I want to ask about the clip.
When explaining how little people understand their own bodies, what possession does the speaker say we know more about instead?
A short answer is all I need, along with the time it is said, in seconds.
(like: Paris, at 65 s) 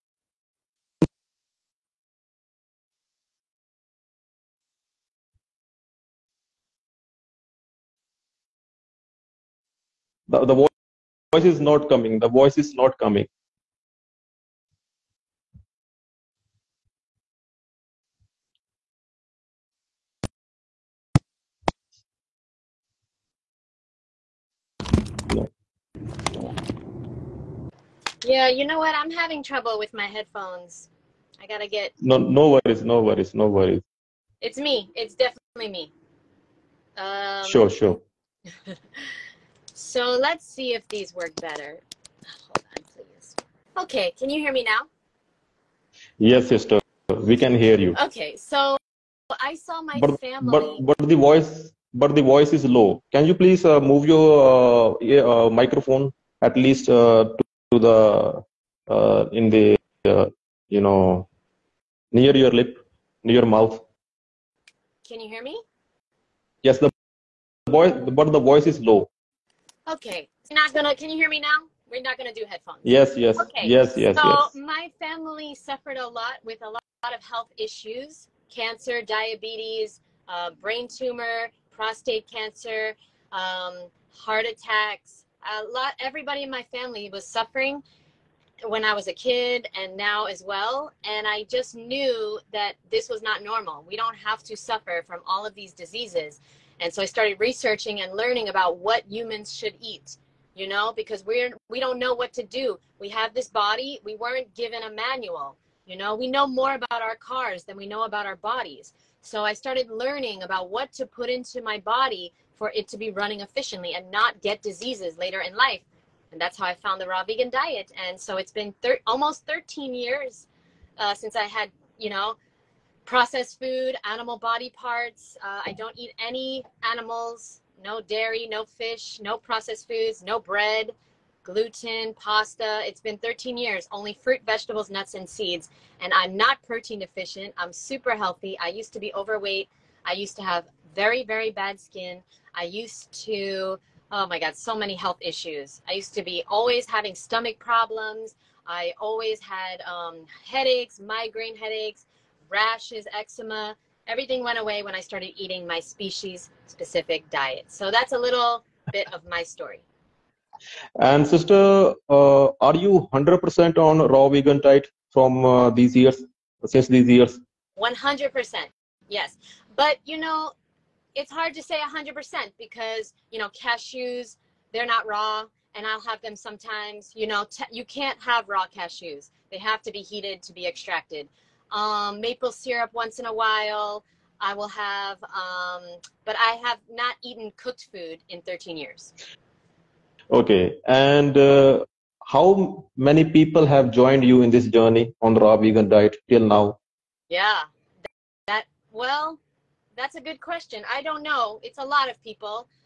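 cars, at 107 s.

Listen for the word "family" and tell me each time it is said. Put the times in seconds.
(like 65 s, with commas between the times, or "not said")
50 s, 74 s, 86 s.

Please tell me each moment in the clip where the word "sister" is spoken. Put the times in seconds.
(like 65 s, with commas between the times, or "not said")
46 s, 161 s.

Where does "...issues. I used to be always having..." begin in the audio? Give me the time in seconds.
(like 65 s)
145 s.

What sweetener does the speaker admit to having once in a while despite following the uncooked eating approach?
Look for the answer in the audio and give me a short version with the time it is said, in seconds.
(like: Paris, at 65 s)
maple syrup, at 182 s.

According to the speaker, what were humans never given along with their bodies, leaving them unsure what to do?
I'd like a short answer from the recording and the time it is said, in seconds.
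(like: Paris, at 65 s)
a manual, at 104 s.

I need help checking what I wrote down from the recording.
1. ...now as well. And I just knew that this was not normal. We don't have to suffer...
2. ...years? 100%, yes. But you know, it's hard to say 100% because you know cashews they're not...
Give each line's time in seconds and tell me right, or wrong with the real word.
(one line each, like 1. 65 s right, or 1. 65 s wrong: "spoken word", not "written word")
1. 89 s right
2. 167 s right.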